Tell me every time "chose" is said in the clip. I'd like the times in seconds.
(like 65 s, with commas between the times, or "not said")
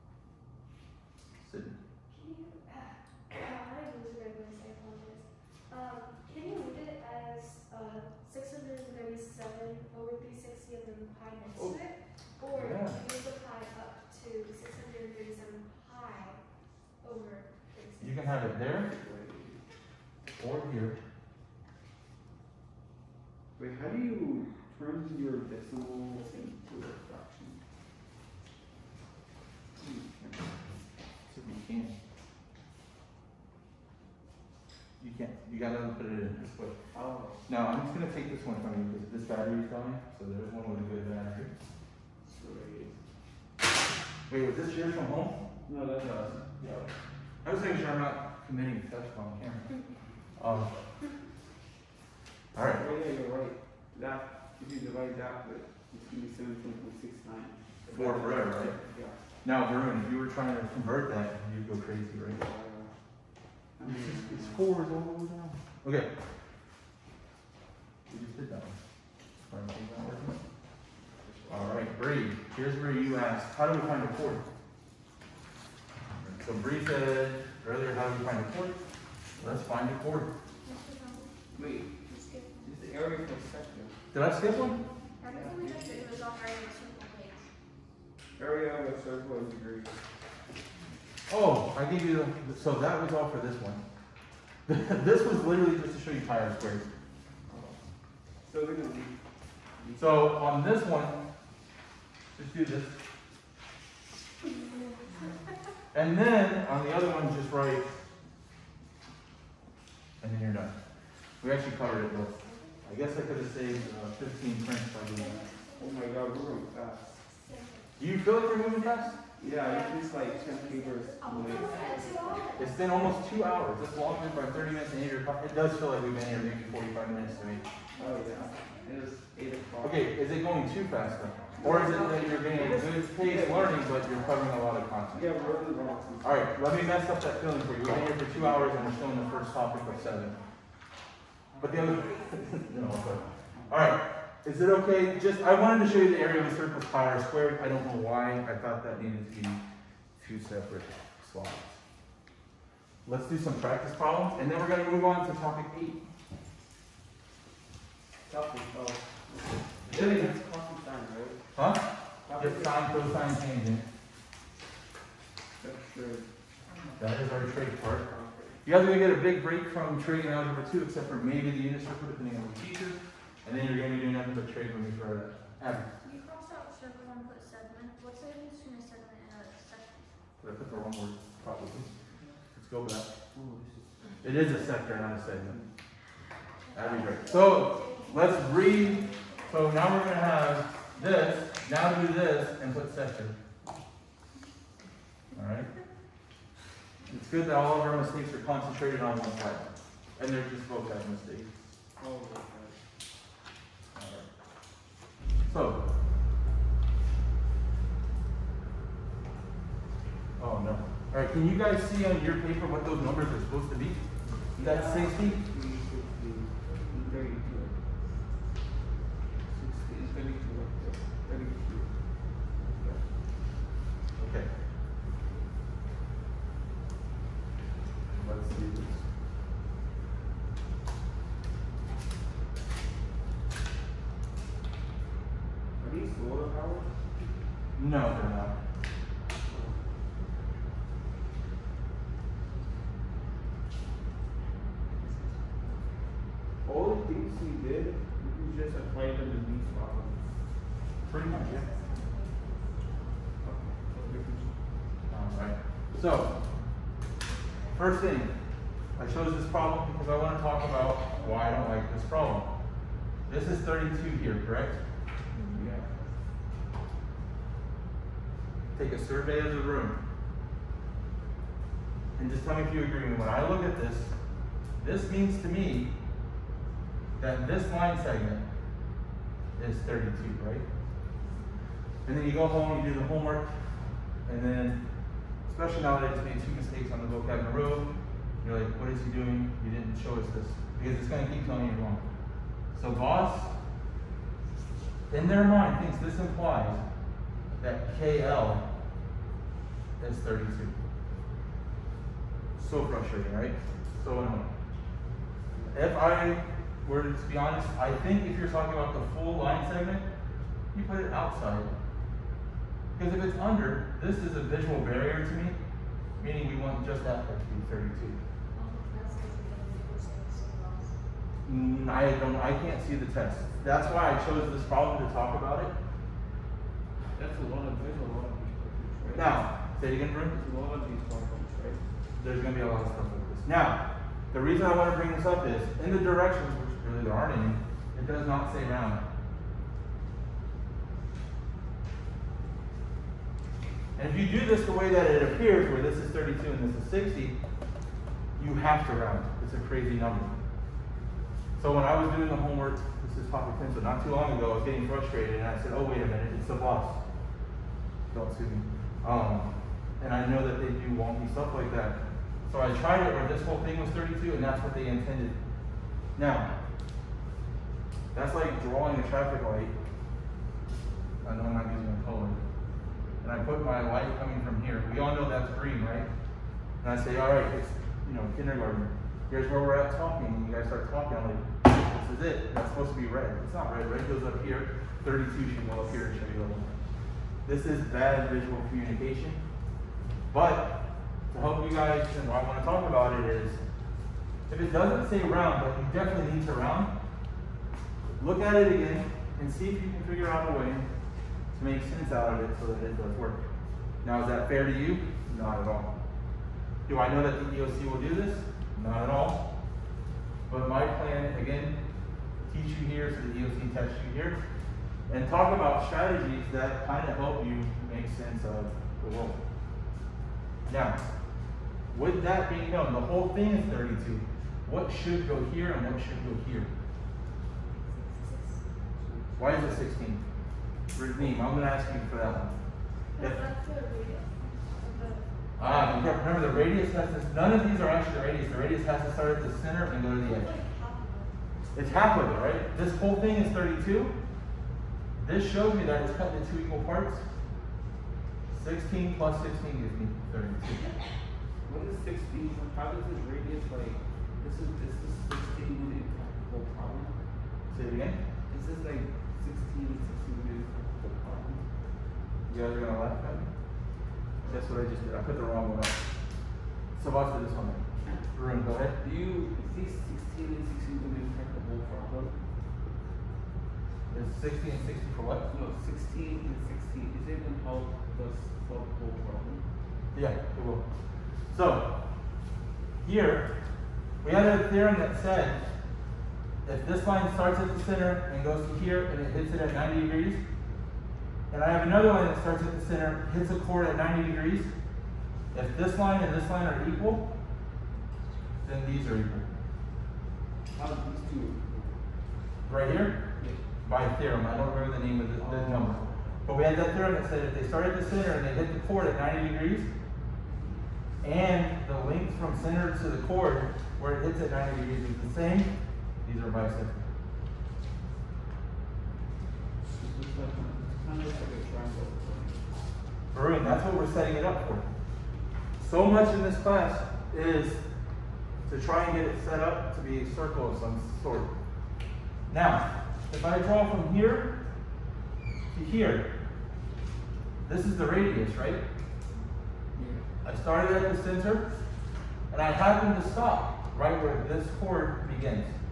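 259 s, 324 s.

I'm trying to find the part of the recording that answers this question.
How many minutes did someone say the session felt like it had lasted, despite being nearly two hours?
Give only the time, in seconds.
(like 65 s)
126 s.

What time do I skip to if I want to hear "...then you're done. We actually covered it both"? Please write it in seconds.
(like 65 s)
110 s.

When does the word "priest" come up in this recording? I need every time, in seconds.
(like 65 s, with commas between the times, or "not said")
not said.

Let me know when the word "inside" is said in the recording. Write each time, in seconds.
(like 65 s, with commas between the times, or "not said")
not said.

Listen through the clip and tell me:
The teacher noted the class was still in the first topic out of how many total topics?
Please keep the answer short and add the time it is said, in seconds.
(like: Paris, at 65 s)
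seven, at 139 s.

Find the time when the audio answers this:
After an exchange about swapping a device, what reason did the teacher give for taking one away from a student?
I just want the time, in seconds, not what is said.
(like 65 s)
39 s.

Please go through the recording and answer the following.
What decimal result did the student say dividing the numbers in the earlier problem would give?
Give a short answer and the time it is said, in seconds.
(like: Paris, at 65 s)
17.69, at 56 s.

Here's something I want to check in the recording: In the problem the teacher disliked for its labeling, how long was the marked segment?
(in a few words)
32.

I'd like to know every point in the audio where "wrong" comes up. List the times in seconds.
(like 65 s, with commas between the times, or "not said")
135 s, 180 s, 291 s, 465 s.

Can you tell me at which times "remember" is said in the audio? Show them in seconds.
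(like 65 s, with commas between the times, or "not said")
436 s, 504 s.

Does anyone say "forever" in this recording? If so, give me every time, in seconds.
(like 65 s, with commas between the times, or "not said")
58 s, 174 s.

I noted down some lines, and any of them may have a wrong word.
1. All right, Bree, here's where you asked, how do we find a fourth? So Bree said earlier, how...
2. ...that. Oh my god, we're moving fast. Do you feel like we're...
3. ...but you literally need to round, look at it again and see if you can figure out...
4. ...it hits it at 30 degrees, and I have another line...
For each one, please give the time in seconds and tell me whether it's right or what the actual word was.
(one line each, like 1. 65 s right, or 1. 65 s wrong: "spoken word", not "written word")
1. 71 s right
2. 115 s right
3. 395 s wrong: "definitely", not "literally"
4. 489 s wrong: "90", not "30".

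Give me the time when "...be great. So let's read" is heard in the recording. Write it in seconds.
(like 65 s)
187 s.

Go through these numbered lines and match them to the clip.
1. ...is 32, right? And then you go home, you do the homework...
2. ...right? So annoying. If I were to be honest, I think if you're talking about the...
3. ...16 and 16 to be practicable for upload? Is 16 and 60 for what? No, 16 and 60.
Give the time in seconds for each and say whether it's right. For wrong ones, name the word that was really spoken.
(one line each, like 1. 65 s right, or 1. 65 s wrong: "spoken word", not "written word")
1. 279 s right
2. 303 s right
3. 470 s right.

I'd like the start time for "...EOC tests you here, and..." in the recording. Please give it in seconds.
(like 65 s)
413 s.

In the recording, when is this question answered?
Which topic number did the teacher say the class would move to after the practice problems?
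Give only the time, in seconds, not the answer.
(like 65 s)
155 s.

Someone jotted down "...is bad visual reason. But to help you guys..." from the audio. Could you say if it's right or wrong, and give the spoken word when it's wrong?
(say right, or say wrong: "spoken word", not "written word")
wrong: "communication", not "reason".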